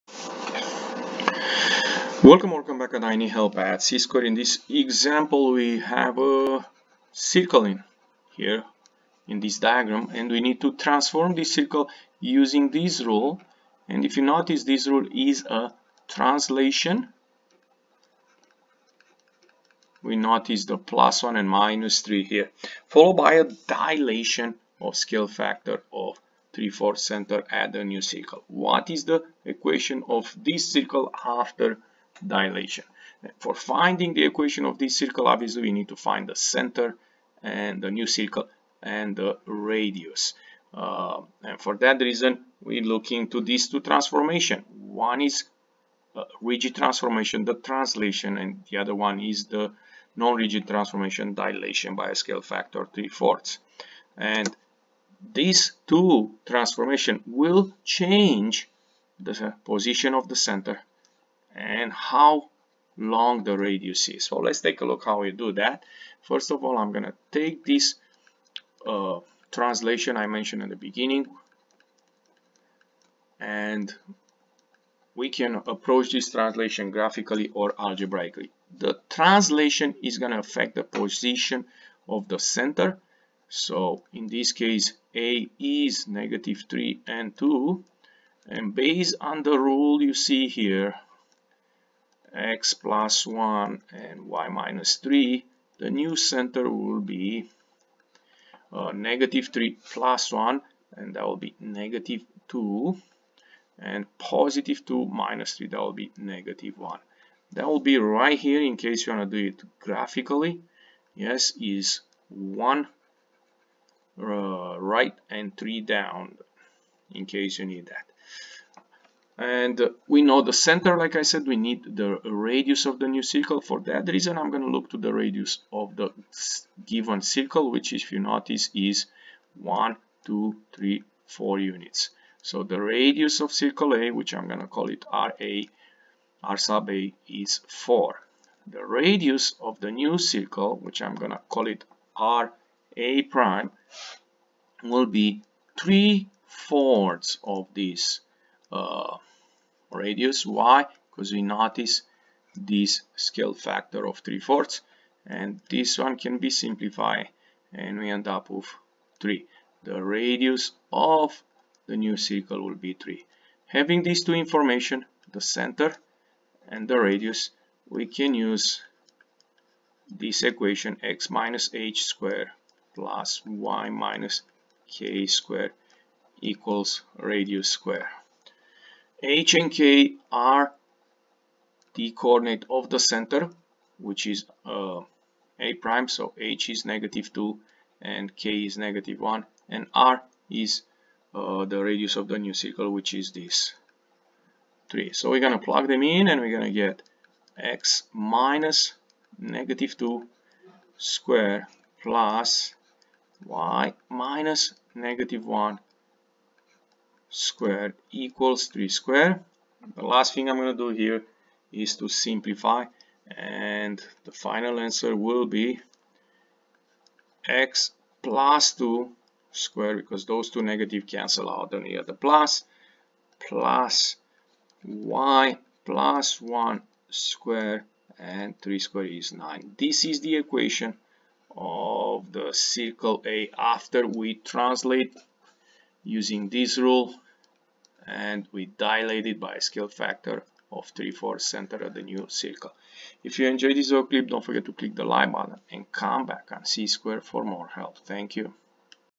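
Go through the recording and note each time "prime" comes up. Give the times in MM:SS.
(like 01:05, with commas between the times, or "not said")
02:23, 03:05.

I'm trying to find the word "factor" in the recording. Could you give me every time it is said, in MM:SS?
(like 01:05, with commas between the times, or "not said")
00:25, 00:52, 02:33, 03:59.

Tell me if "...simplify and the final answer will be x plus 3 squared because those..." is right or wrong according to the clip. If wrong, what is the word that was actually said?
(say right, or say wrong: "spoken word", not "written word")
wrong: "2", not "3".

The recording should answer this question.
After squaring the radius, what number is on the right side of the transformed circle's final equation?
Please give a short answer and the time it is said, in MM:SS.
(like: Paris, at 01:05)
9, at 03:49.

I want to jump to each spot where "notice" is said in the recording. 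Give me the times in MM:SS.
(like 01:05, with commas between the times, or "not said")
00:14, 00:20, 02:08, 02:31.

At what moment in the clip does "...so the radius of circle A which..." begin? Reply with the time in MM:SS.
02:12.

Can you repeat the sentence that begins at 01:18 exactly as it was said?
The translation is going to affect the position of the center.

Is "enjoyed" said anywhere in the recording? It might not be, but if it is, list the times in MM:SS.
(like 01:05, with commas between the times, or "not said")
04:03.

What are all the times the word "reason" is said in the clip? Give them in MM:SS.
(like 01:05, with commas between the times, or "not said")
00:42, 02:04.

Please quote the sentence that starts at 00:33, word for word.
For finding the equation of this circle, obviously we need to find the center and the new circle and the radius.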